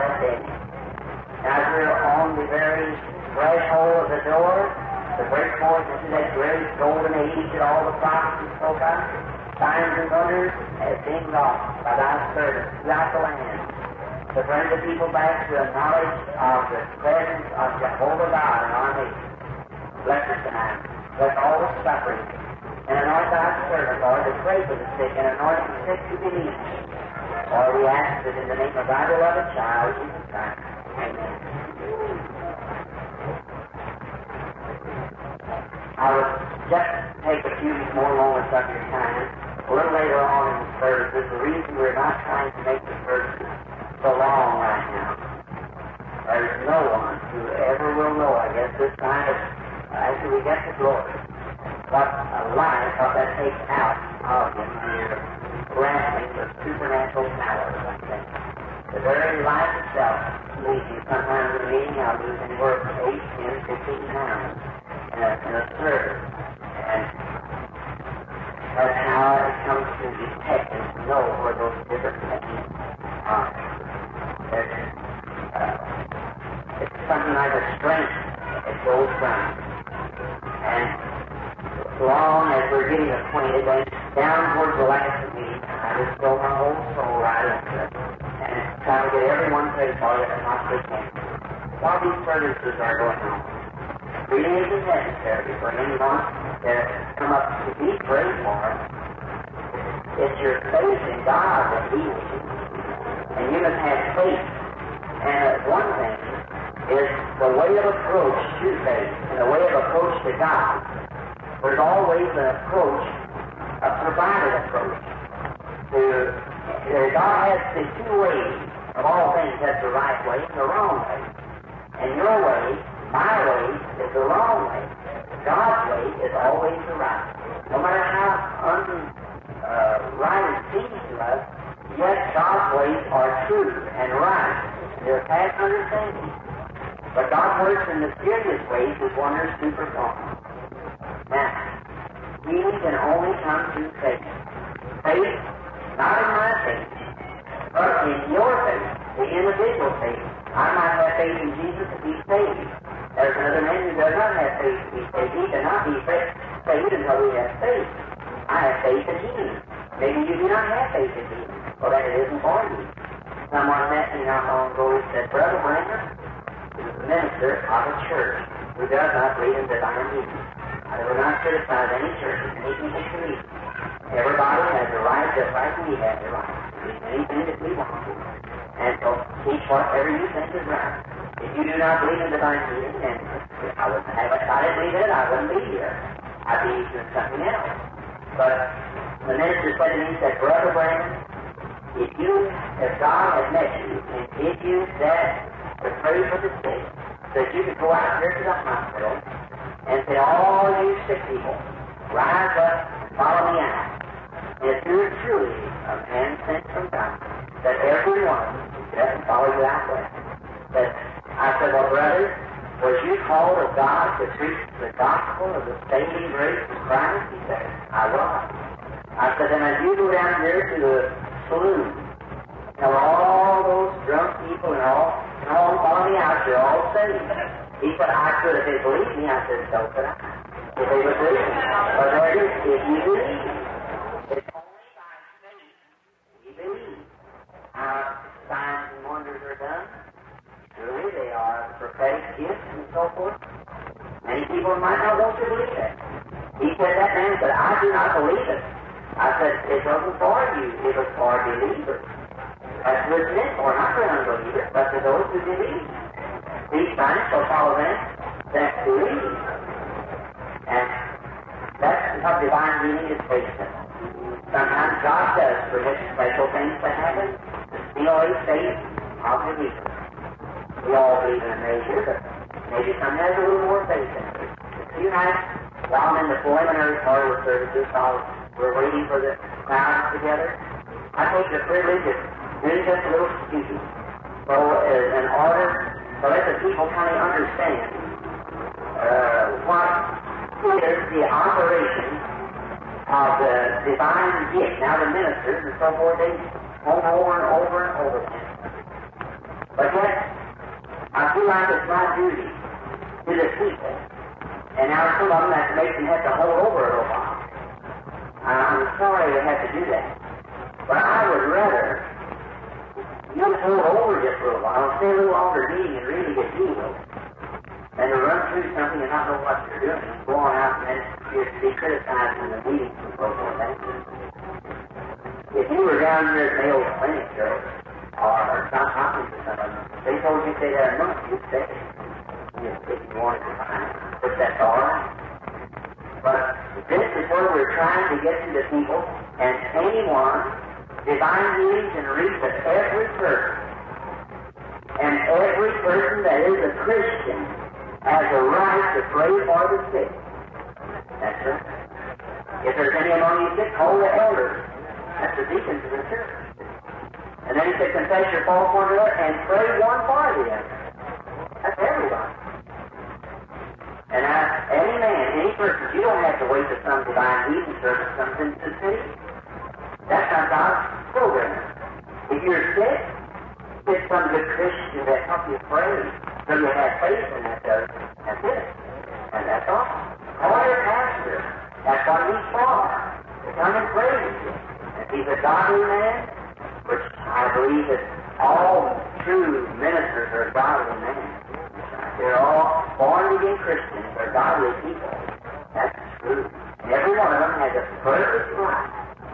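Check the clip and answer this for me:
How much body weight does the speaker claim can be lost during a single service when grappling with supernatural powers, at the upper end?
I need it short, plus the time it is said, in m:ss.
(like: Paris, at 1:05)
15 pounds, at 1:03.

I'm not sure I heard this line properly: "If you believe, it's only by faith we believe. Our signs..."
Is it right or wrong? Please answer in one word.
right.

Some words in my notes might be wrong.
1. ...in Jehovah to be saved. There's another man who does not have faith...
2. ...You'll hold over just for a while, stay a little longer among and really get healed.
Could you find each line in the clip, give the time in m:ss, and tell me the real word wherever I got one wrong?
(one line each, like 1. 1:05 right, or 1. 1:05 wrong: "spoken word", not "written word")
1. 2:31 wrong: "Jesus", not "Jehovah"
2. 5:13 wrong: "reading", not "among".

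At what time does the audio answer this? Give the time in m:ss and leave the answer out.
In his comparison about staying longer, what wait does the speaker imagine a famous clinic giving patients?
5:31.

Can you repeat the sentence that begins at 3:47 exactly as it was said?
He could ask you if they believe me.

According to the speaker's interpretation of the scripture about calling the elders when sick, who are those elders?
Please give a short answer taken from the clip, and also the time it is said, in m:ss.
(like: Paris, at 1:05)
the deacons, at 5:55.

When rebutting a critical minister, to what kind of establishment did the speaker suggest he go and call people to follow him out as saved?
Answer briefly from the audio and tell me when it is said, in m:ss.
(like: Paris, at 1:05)
saloon, at 3:41.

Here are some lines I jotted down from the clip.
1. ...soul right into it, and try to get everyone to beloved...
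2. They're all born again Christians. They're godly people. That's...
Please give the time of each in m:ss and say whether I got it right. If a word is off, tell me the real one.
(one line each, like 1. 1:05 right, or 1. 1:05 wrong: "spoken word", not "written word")
1. 1:26 wrong: "saved", not "beloved"
2. 6:32 right.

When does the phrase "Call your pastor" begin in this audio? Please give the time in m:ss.
6:20.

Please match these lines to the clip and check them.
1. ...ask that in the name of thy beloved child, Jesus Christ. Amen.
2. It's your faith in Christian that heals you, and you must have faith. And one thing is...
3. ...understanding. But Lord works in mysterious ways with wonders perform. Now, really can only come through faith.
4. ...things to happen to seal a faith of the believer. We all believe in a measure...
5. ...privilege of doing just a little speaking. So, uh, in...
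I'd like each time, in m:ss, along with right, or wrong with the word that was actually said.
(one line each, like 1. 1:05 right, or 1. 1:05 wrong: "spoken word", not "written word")
1. 0:27 right
2. 1:40 wrong: "God", not "Christian"
3. 2:15 wrong: "God", not "Lord"
4. 4:26 right
5. 4:41 right.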